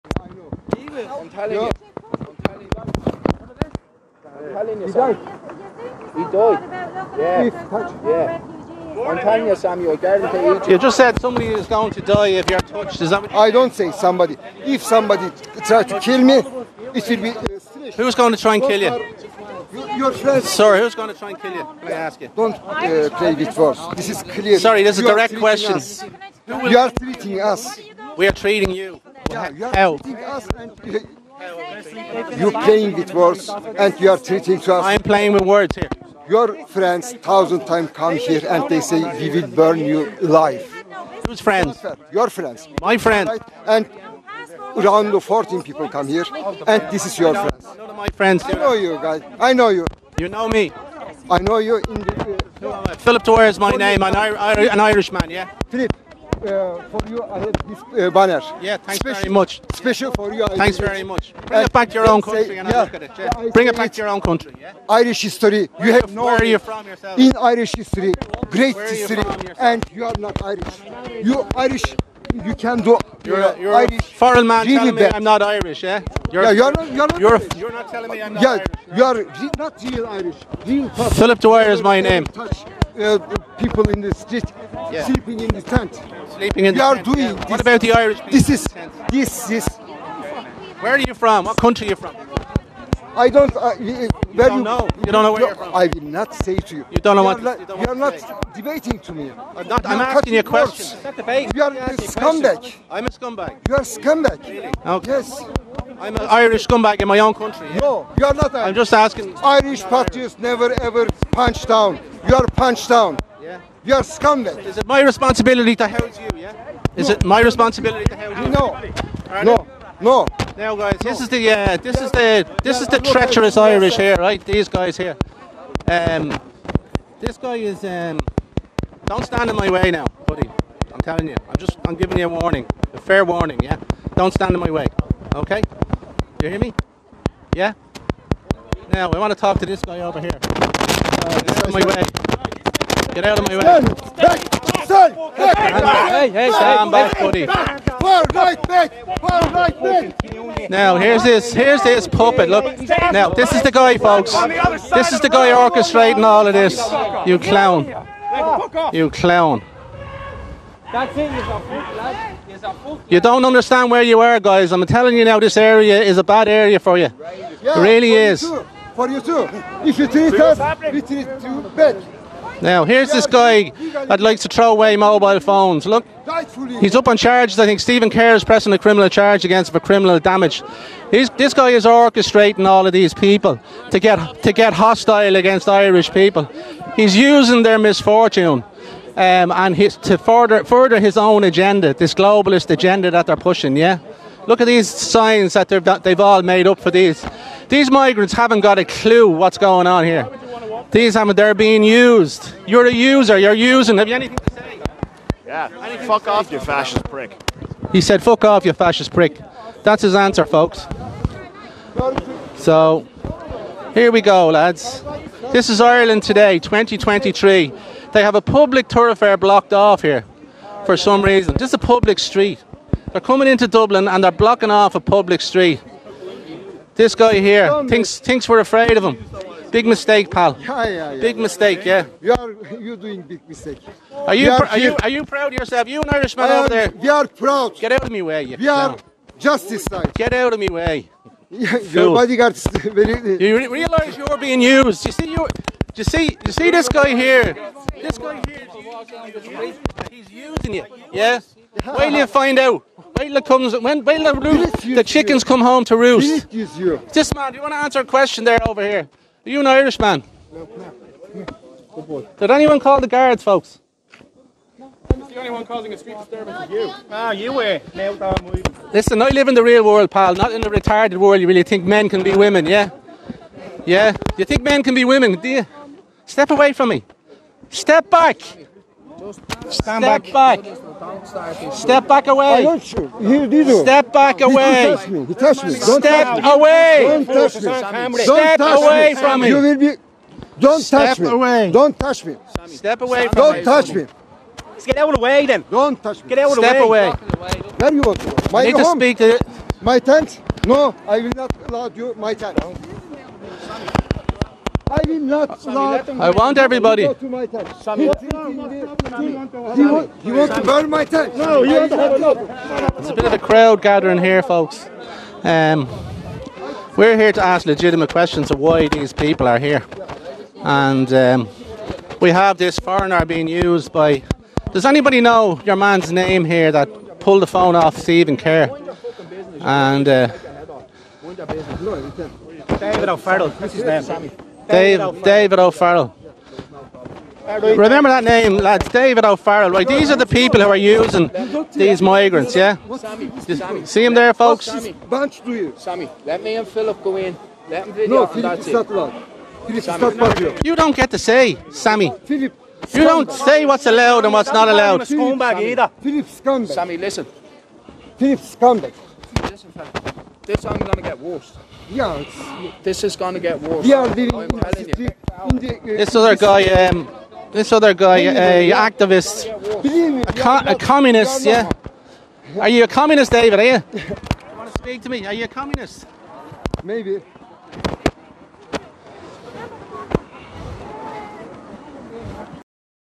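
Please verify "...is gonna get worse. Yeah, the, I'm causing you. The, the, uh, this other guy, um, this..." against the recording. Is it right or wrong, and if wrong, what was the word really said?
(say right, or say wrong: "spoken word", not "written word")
wrong: "telling", not "causing".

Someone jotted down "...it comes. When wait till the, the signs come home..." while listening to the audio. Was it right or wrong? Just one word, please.
wrong.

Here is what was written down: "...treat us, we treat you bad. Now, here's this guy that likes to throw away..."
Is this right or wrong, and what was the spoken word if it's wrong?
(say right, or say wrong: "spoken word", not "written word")
right.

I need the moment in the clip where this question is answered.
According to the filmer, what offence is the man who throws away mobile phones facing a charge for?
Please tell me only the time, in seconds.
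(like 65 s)
179 s.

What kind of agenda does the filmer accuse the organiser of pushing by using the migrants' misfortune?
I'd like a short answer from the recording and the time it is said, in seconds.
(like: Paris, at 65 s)
globalist agenda, at 192 s.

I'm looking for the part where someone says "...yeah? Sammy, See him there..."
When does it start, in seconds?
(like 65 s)
342 s.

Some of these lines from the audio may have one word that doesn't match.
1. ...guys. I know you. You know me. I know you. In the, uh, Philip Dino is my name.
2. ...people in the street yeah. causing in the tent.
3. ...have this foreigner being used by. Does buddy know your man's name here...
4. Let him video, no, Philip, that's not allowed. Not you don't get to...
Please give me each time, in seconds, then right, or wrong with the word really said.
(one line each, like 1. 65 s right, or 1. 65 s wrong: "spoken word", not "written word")
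1. 49 s wrong: "Torres", not "Dino"
2. 83 s wrong: "sleeping", not "causing"
3. 322 s wrong: "anybody", not "buddy"
4. 347 s right.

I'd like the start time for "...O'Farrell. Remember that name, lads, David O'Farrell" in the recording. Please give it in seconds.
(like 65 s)
335 s.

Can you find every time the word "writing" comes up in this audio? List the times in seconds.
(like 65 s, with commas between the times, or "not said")
not said.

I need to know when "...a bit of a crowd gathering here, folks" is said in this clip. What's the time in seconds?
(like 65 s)
313 s.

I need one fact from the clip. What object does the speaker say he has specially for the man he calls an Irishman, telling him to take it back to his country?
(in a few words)
banner.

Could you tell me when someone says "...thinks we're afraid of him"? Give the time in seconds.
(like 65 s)
228 s.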